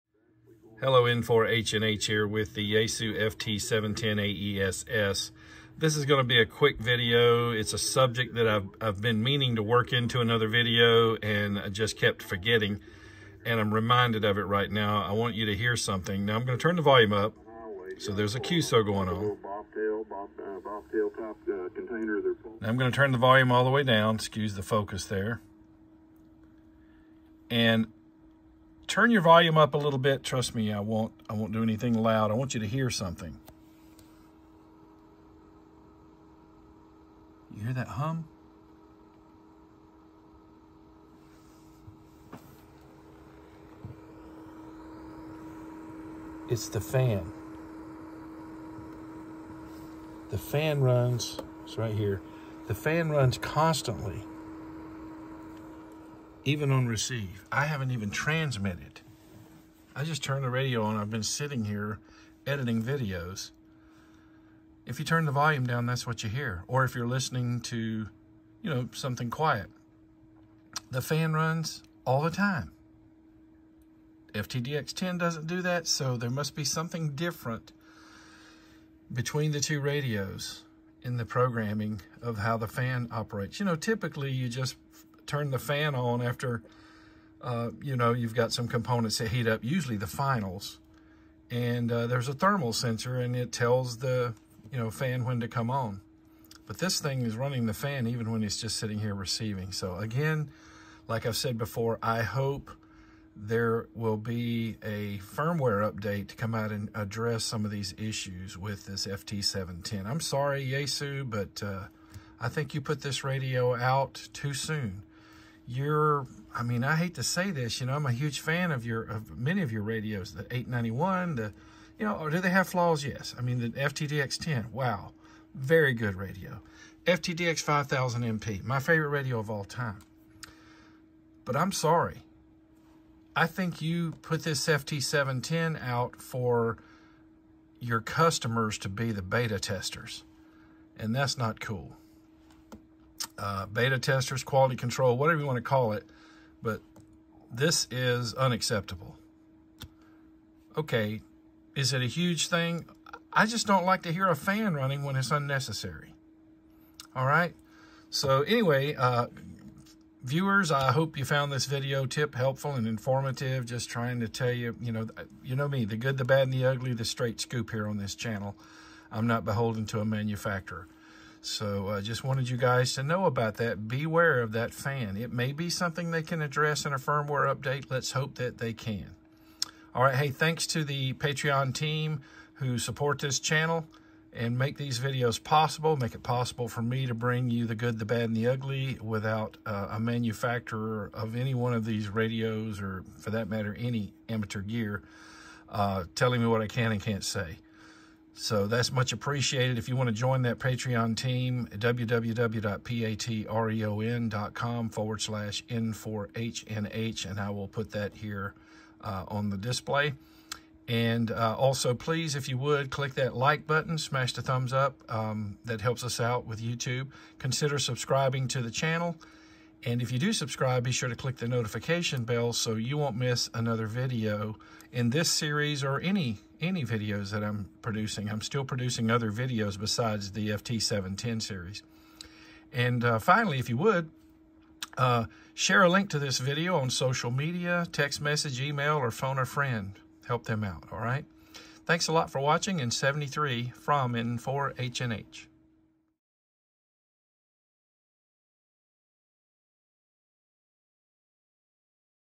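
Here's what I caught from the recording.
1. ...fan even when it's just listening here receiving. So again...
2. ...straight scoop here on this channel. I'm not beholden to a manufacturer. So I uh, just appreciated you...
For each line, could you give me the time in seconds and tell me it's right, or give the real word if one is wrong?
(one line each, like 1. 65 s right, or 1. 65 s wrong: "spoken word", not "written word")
1. 97 s wrong: "sitting", not "listening"
2. 167 s wrong: "wanted", not "appreciated".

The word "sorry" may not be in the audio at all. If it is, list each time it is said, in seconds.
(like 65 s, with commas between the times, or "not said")
110 s, 131 s.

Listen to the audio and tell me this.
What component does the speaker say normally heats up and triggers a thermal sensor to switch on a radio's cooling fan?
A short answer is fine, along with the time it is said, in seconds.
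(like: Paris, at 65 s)
the finals, at 89 s.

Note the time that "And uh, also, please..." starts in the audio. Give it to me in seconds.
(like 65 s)
210 s.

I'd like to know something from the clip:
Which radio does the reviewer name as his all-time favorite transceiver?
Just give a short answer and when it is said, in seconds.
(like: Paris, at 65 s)
FTDX 5000 MP, at 127 s.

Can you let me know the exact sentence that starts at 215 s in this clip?
Um, that helps us out with YouTube.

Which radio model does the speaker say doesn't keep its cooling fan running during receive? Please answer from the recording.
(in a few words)
FTDX10.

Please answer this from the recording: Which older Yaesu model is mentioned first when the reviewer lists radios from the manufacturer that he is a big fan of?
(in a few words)
891.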